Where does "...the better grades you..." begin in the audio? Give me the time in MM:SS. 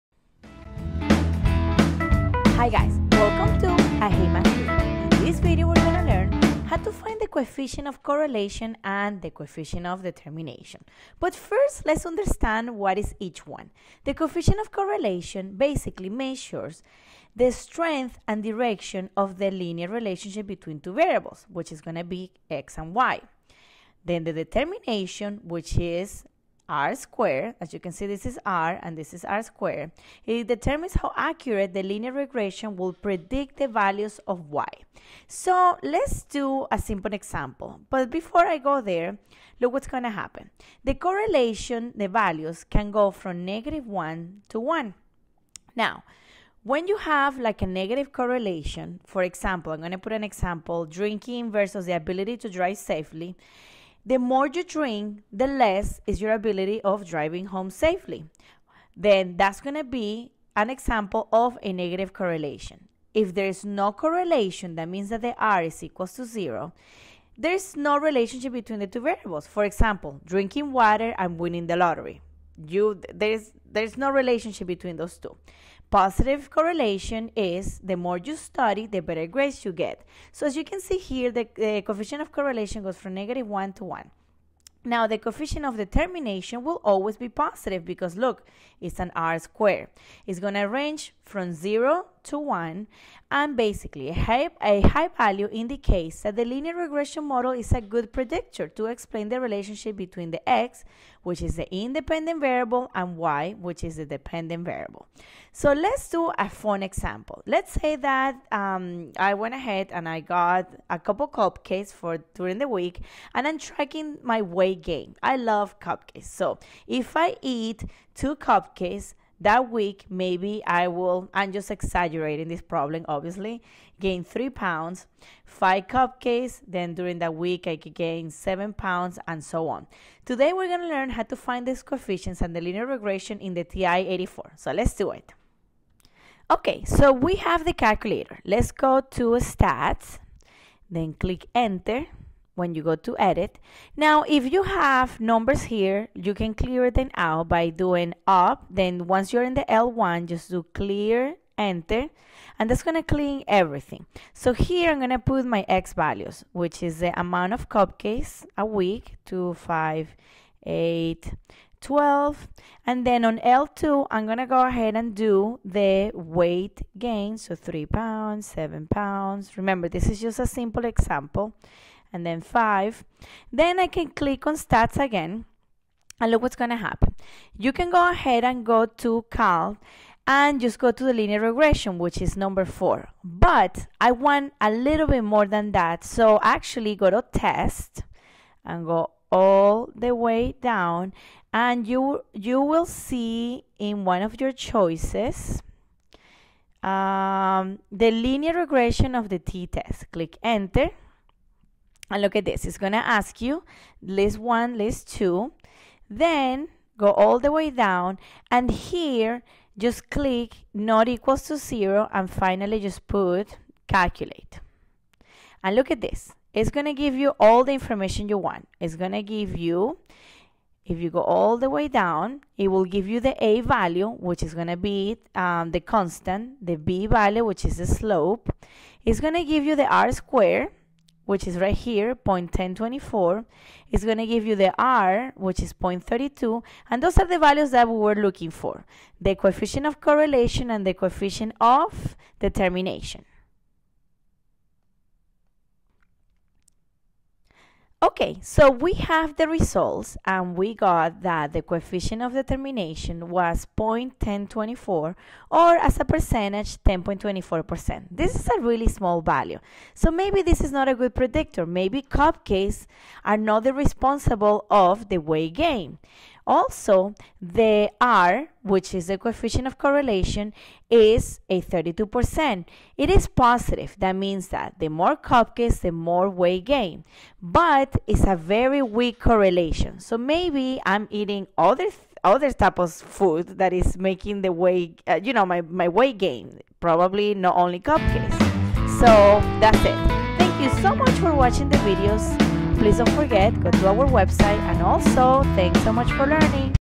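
01:18.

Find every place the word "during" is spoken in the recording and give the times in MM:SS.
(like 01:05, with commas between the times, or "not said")
01:52, 02:06.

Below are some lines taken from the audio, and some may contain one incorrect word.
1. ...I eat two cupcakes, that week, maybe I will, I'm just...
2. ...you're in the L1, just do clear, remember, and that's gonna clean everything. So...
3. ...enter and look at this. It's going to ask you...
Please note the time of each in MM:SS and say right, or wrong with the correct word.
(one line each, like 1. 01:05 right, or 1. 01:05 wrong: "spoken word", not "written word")
1. 01:57 right
2. 02:29 wrong: "enter", not "remember"
3. 03:20 right.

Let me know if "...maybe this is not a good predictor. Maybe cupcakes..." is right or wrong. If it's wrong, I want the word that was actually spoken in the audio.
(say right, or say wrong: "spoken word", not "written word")
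right.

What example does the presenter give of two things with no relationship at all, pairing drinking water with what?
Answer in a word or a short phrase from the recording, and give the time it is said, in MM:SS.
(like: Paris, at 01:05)
Winning the lottery, at 01:11.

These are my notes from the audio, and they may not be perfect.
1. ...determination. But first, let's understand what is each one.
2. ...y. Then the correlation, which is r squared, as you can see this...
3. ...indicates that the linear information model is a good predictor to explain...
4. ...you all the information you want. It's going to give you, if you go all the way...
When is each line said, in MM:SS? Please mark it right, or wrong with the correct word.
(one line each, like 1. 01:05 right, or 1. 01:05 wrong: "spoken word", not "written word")
1. 00:10 right
2. 00:22 wrong: "determination", not "correlation"
3. 01:35 wrong: "regression", not "information"
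4. 03:37 right.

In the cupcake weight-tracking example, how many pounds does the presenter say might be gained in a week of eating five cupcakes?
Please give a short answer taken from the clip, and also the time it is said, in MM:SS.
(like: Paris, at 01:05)
7, at 02:08.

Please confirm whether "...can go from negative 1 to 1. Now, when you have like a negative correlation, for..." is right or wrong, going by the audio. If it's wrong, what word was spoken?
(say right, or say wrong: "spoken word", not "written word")
right.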